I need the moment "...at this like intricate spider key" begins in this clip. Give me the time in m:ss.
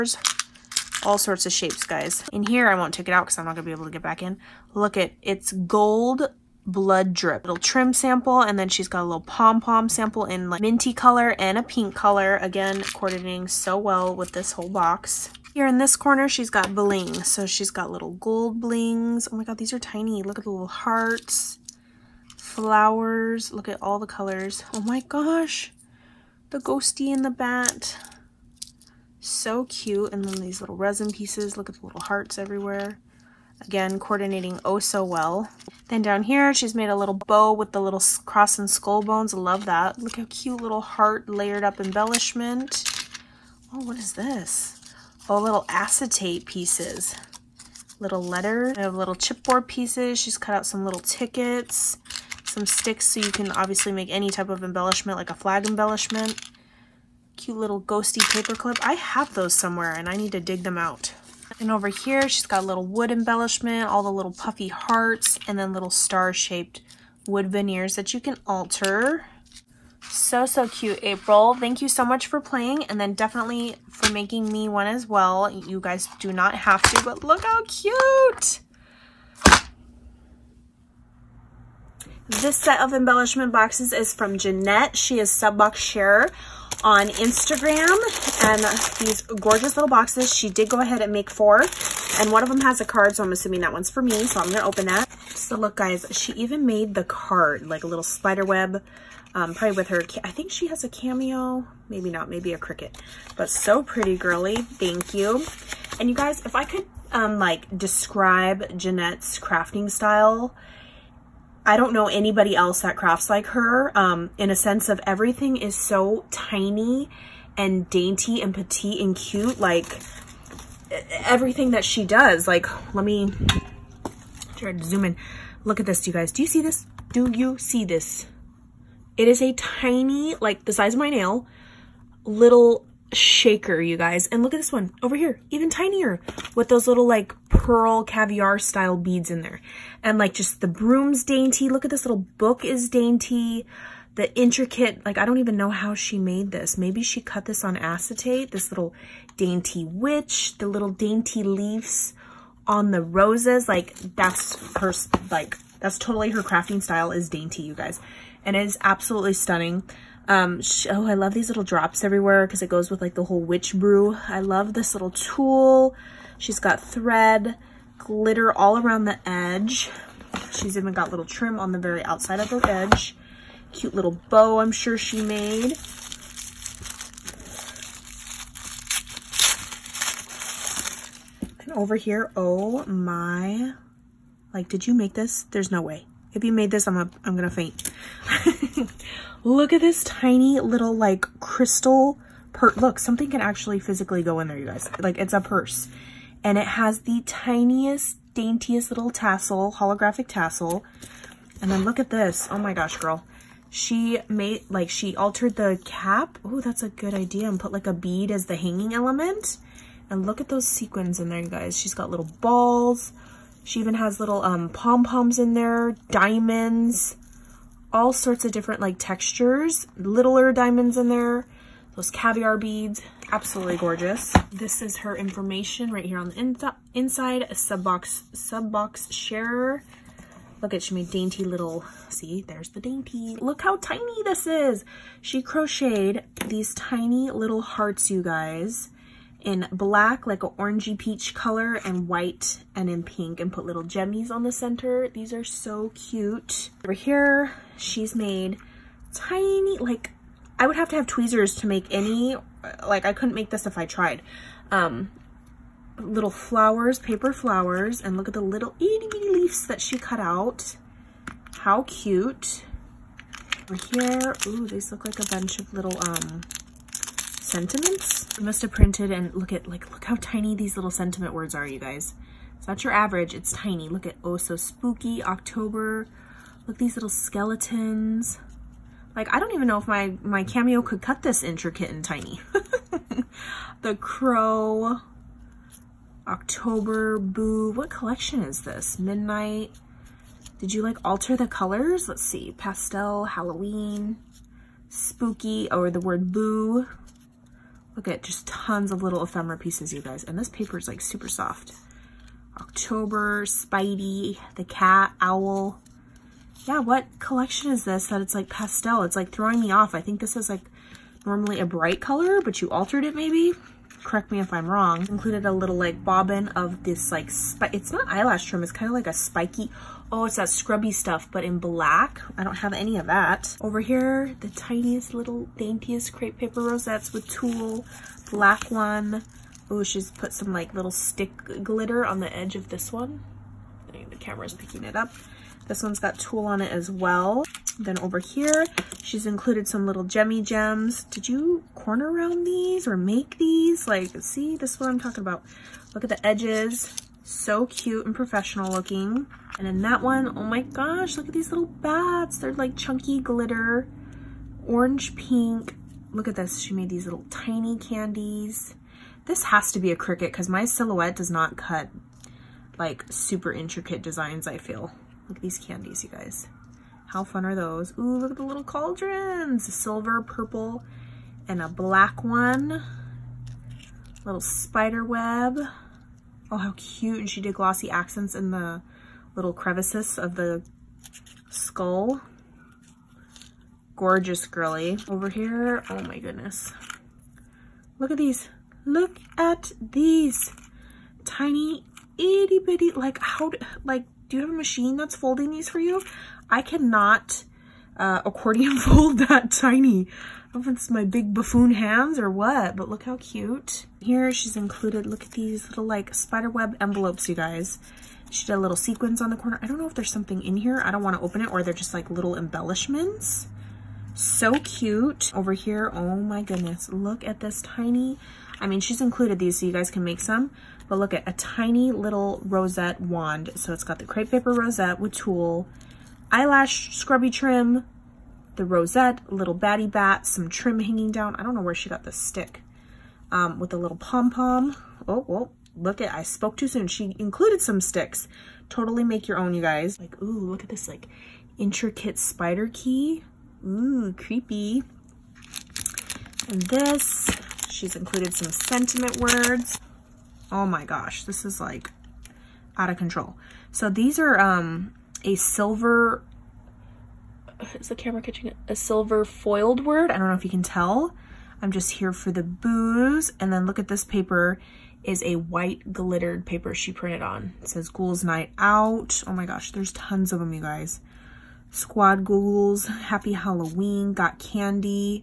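7:20.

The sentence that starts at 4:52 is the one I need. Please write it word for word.
Let's see, pastel, Halloween, spooky, or the word boo, Look at just tons of little ephemera pieces, you guys.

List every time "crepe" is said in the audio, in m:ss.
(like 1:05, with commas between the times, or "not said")
5:26, 7:04.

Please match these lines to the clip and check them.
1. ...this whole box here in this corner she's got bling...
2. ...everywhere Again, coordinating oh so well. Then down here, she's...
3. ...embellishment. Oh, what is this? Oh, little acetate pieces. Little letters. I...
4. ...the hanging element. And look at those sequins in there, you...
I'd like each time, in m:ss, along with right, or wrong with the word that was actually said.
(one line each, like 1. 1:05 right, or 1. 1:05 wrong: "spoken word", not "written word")
1. 0:14 right
2. 0:32 right
3. 0:41 right
4. 3:28 right.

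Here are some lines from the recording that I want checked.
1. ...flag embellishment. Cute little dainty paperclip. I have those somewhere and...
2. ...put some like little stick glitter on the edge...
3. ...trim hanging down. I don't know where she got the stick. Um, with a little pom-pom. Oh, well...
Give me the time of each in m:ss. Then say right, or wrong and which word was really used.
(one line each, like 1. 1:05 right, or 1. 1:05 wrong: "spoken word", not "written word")
1. 0:55 wrong: "ghosty", not "dainty"
2. 5:30 right
3. 7:10 right.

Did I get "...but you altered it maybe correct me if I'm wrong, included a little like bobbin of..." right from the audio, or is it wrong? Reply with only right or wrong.
right.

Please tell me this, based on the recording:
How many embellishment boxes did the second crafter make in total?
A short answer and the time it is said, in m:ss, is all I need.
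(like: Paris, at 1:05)
4, at 1:31.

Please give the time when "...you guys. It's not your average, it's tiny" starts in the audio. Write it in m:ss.
4:31.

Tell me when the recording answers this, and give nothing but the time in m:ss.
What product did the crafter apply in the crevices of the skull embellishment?
6:17.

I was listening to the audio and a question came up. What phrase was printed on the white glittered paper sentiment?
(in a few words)
Ghouls Night Out.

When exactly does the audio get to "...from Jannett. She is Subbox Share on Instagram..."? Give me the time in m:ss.
1:24.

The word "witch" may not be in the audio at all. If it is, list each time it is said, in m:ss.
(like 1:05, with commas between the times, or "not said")
2:29, 2:43.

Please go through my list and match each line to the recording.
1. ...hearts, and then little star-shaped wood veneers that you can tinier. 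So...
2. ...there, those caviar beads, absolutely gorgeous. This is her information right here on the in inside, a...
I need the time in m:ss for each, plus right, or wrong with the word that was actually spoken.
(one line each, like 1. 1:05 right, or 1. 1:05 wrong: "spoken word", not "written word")
1. 1:04 wrong: "alter", not "tinier"
2. 3:41 right.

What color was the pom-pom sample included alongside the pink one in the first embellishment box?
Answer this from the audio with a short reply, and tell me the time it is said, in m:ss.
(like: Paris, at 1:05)
Minty, at 0:10.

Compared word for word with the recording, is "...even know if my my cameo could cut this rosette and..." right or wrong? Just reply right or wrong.
wrong.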